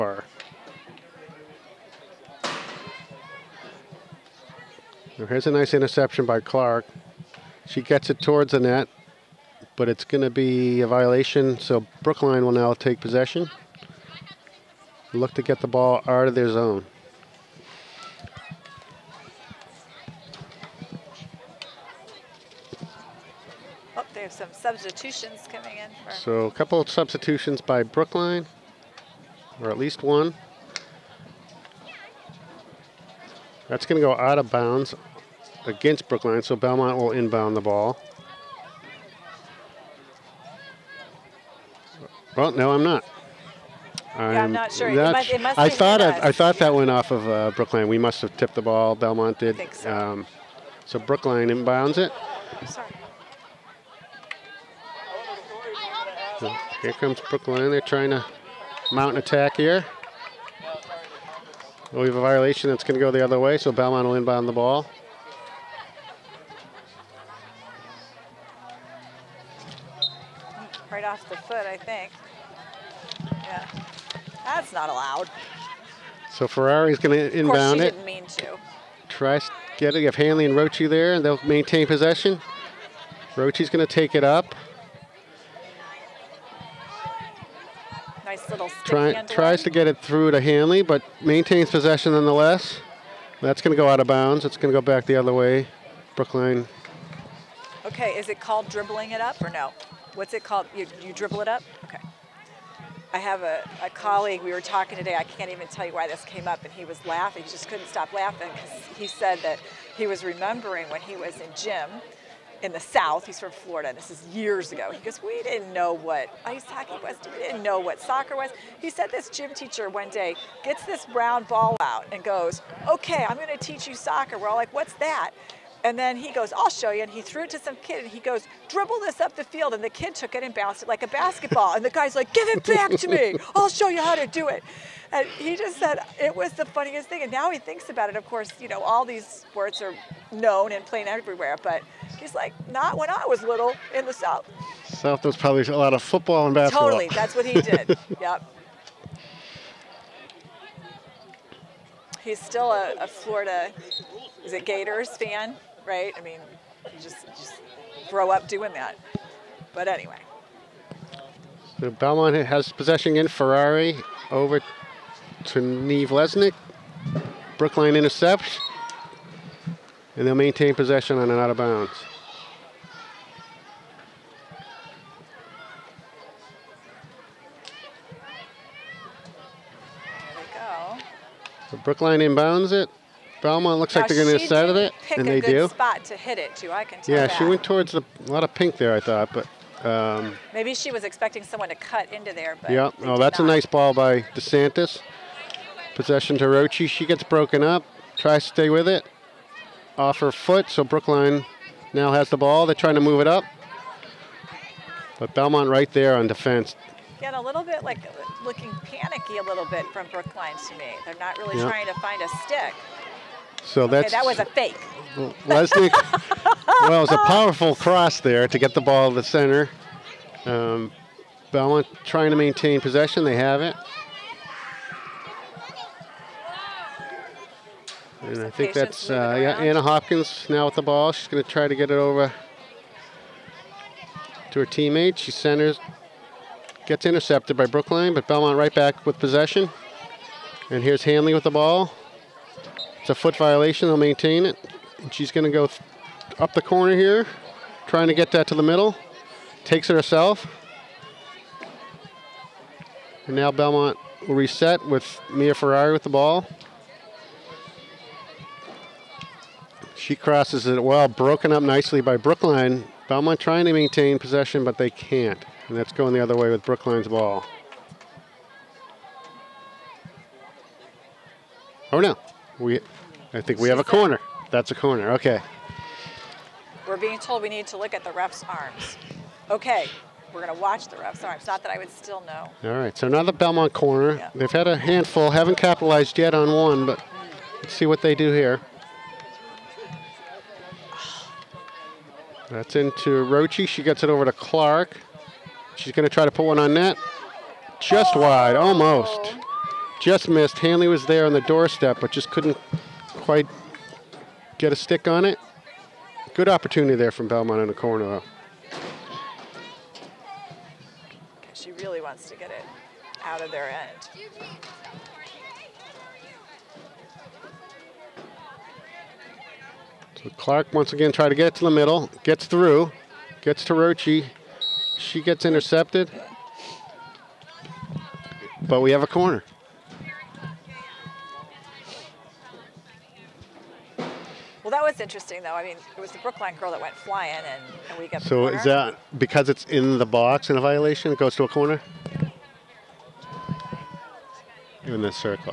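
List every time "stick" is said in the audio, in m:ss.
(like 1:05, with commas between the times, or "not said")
3:32, 5:04.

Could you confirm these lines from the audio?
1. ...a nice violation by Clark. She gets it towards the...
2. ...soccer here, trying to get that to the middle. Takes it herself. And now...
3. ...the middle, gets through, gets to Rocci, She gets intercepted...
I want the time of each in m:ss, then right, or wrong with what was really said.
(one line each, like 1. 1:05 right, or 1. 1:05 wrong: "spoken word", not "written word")
1. 0:05 wrong: "interception", not "violation"
2. 4:06 wrong: "corner", not "soccer"
3. 5:21 right.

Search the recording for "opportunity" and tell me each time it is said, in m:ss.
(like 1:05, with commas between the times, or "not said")
5:06.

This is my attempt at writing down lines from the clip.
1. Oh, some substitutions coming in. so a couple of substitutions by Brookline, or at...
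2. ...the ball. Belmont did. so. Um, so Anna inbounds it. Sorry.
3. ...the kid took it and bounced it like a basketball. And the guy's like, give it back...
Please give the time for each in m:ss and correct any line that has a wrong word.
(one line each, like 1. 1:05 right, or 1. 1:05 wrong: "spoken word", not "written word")
1. 0:23 right
2. 0:48 wrong: "Brookline", not "Anna"
3. 2:09 right.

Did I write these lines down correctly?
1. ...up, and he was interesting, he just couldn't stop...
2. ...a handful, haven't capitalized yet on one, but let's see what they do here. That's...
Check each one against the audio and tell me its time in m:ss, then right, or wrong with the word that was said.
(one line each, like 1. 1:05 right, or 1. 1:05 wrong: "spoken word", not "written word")
1. 1:46 wrong: "laughing", not "interesting"
2. 4:44 right.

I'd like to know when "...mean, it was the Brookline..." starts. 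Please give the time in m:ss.
5:35.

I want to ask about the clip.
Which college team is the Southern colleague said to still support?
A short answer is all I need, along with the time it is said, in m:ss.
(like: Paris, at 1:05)
Gators, at 2:34.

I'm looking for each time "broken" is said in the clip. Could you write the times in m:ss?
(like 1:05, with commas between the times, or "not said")
3:17, 4:21.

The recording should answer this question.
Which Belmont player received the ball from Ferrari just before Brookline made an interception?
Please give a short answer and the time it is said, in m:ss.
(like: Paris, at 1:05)
Neve Lesnick, at 2:45.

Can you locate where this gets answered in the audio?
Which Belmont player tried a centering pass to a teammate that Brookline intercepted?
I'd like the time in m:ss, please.
3:49.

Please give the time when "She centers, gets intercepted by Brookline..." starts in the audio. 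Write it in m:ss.
3:55.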